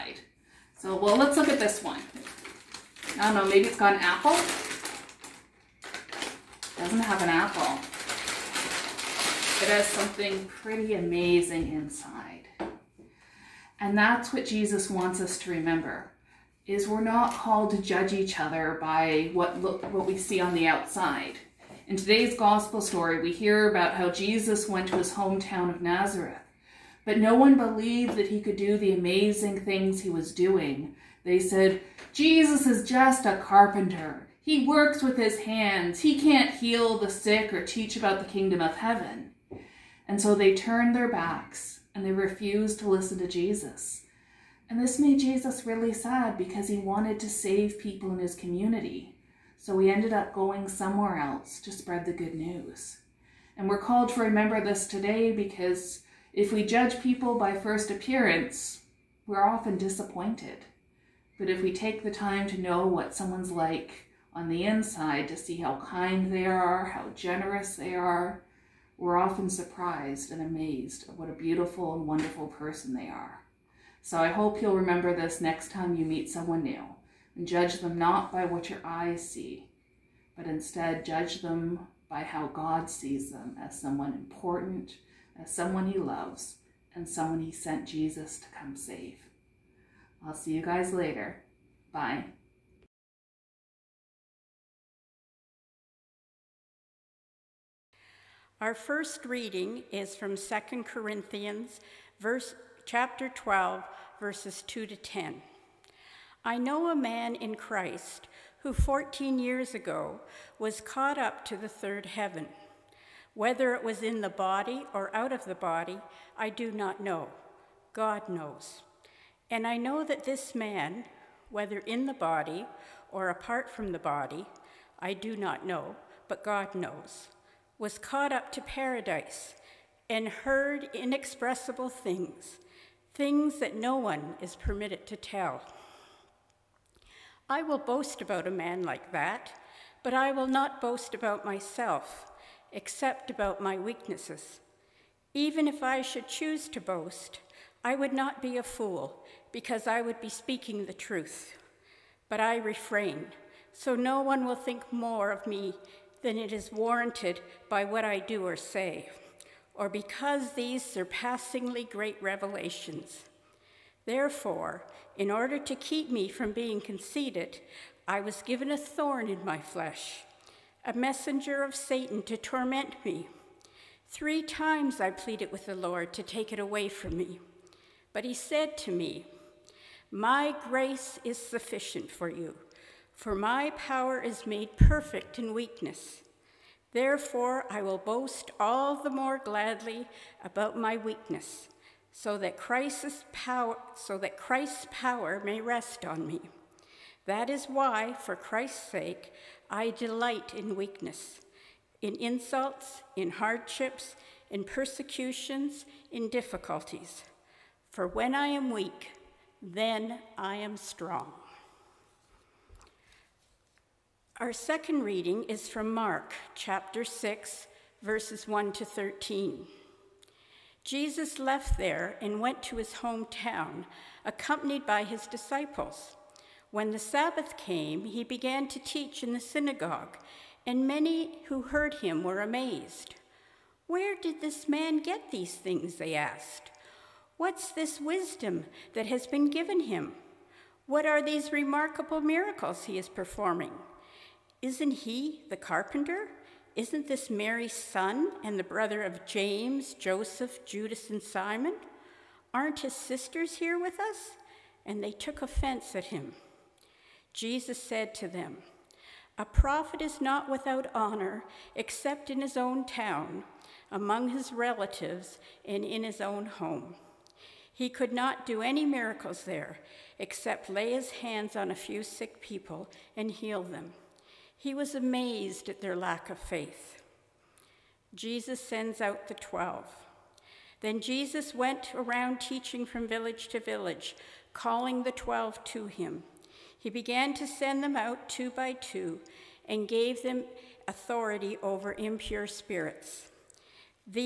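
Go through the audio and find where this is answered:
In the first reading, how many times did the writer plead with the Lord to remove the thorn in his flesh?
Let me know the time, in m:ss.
2:54.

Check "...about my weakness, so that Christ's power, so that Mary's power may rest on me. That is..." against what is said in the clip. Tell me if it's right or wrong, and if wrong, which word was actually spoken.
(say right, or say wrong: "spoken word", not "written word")
wrong: "Christ", not "Mary".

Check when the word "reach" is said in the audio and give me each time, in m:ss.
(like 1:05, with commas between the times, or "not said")
not said.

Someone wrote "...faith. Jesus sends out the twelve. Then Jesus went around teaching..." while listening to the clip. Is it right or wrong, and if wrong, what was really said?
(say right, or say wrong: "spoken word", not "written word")
right.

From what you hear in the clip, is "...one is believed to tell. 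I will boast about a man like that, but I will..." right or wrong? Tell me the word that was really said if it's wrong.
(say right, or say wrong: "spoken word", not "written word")
wrong: "permitted", not "believed".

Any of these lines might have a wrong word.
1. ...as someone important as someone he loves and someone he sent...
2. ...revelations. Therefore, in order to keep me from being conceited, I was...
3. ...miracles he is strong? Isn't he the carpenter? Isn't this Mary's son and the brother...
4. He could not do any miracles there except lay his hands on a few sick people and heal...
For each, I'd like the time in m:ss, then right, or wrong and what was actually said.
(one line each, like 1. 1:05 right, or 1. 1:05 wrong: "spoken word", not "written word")
1. 1:23 right
2. 2:42 right
3. 4:02 wrong: "performing", not "strong"
4. 4:27 right.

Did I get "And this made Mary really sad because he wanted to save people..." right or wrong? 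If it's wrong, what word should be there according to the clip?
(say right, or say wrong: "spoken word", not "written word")
wrong: "Jesus", not "Mary".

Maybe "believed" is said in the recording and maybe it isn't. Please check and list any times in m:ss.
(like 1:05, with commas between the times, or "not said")
0:27.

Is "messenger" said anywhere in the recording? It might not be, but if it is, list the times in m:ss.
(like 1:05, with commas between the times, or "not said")
2:50.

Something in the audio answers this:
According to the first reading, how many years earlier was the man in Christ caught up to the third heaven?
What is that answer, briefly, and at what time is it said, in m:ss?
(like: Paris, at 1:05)
14, at 1:48.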